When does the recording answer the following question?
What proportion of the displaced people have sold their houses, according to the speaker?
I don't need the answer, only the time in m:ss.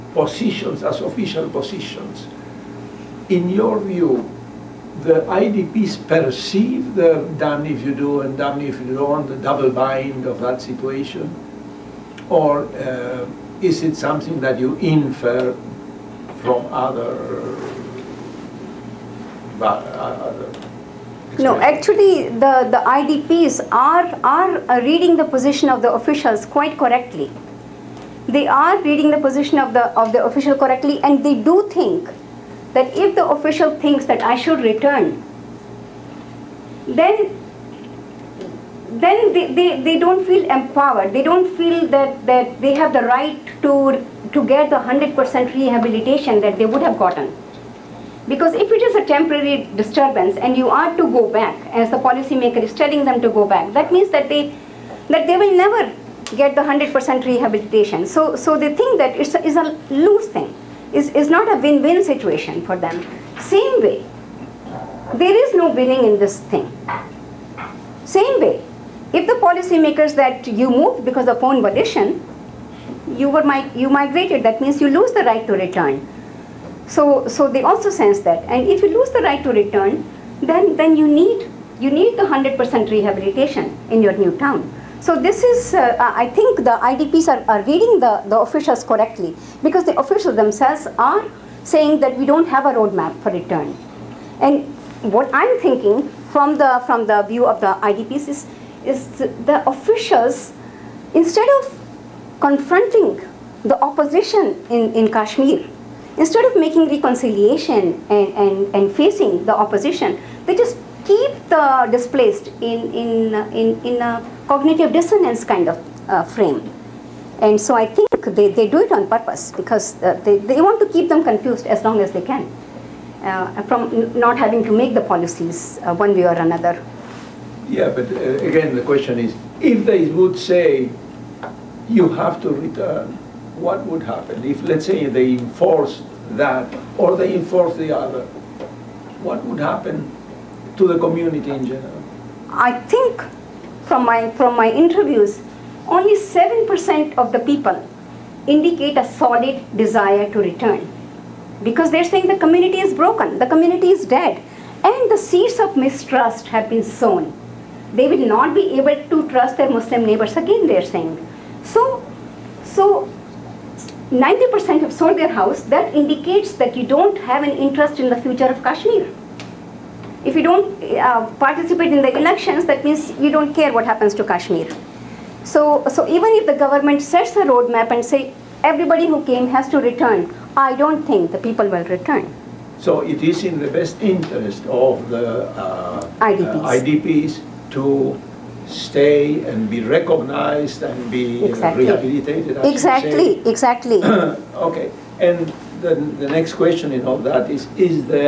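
2:44.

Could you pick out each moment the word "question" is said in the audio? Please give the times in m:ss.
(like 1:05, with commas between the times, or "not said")
2:08, 3:16.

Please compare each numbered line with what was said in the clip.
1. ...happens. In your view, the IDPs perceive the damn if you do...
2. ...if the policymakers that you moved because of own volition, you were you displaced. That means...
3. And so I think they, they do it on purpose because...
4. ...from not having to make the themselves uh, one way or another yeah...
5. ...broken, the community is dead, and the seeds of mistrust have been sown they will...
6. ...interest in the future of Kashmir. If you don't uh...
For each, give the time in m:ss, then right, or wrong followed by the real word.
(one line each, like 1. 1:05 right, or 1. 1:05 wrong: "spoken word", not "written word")
1. 0:01 wrong: "positions", not "happens"
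2. 1:09 wrong: "migrated", not "displaced"
3. 1:57 right
4. 2:03 wrong: "policies", not "themselves"
5. 2:32 right
6. 2:47 right.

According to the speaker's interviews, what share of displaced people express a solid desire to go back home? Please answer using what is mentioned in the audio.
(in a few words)
7%.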